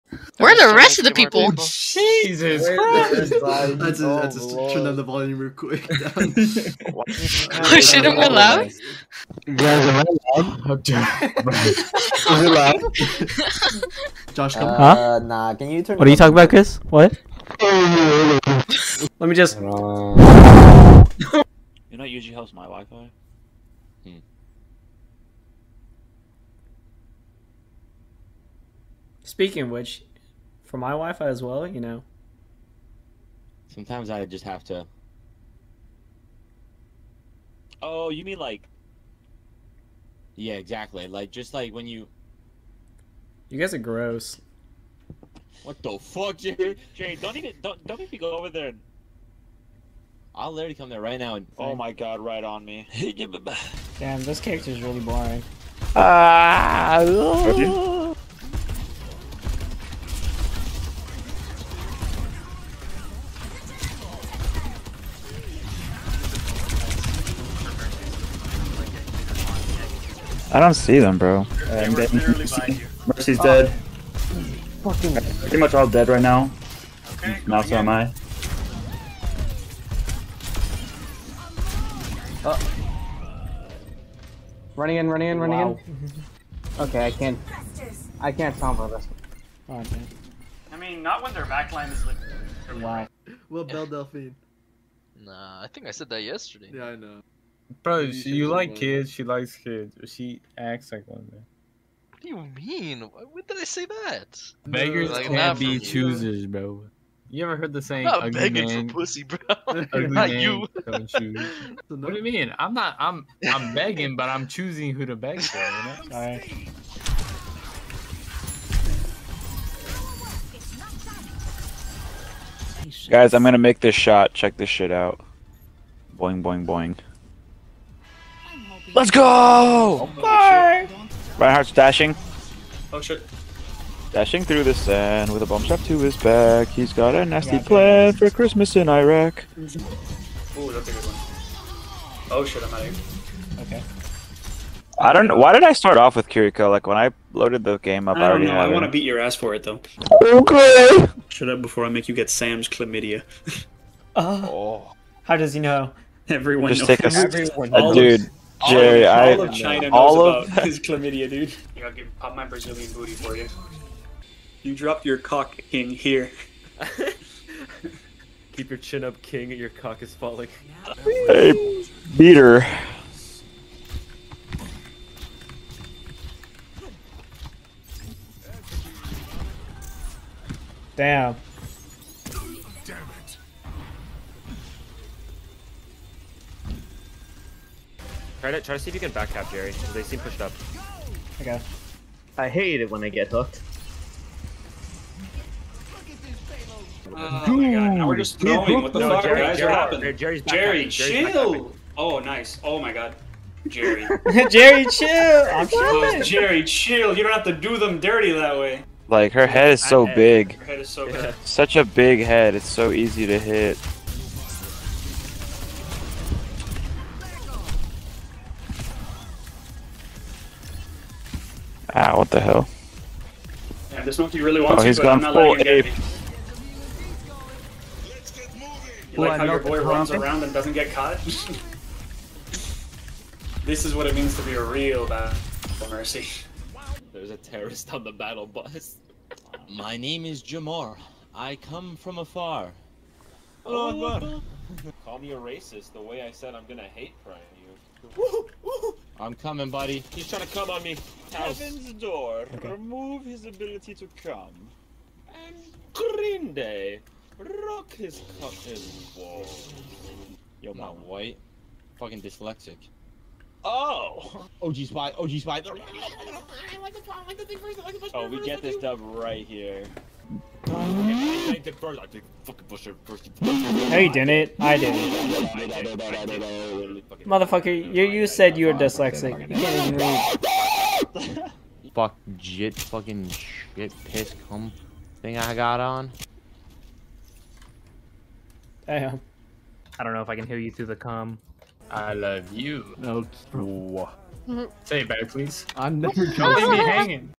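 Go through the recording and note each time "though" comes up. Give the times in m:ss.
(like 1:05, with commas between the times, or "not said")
2:29.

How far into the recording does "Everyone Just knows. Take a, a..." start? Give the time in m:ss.
2:36.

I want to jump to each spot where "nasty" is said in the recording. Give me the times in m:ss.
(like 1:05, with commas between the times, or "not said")
2:17.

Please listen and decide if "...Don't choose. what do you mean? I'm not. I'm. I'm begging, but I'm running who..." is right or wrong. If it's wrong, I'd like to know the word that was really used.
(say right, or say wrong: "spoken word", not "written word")
wrong: "choosing", not "running".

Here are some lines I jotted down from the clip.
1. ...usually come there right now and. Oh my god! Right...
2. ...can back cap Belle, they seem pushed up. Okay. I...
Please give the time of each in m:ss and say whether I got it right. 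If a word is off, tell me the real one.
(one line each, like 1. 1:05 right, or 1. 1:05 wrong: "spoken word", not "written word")
1. 0:50 wrong: "literally", not "usually"
2. 3:08 wrong: "Jerry", not "Belle".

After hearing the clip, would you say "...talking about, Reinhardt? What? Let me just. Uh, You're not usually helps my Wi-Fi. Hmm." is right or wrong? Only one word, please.
wrong.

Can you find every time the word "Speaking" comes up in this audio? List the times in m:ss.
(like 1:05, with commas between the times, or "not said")
0:29.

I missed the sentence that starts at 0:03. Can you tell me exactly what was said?
That's a, that's a oh, turn down the volume real quick.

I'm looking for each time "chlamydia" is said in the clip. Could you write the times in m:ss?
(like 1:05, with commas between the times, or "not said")
2:32, 2:40.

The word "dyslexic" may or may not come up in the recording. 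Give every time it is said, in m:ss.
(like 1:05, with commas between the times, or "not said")
4:22, 4:38.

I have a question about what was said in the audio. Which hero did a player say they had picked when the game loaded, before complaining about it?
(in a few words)
Kiriko.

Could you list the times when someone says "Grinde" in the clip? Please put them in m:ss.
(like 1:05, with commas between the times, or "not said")
4:15.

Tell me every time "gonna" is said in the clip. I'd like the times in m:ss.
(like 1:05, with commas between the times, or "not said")
2:03, 4:06.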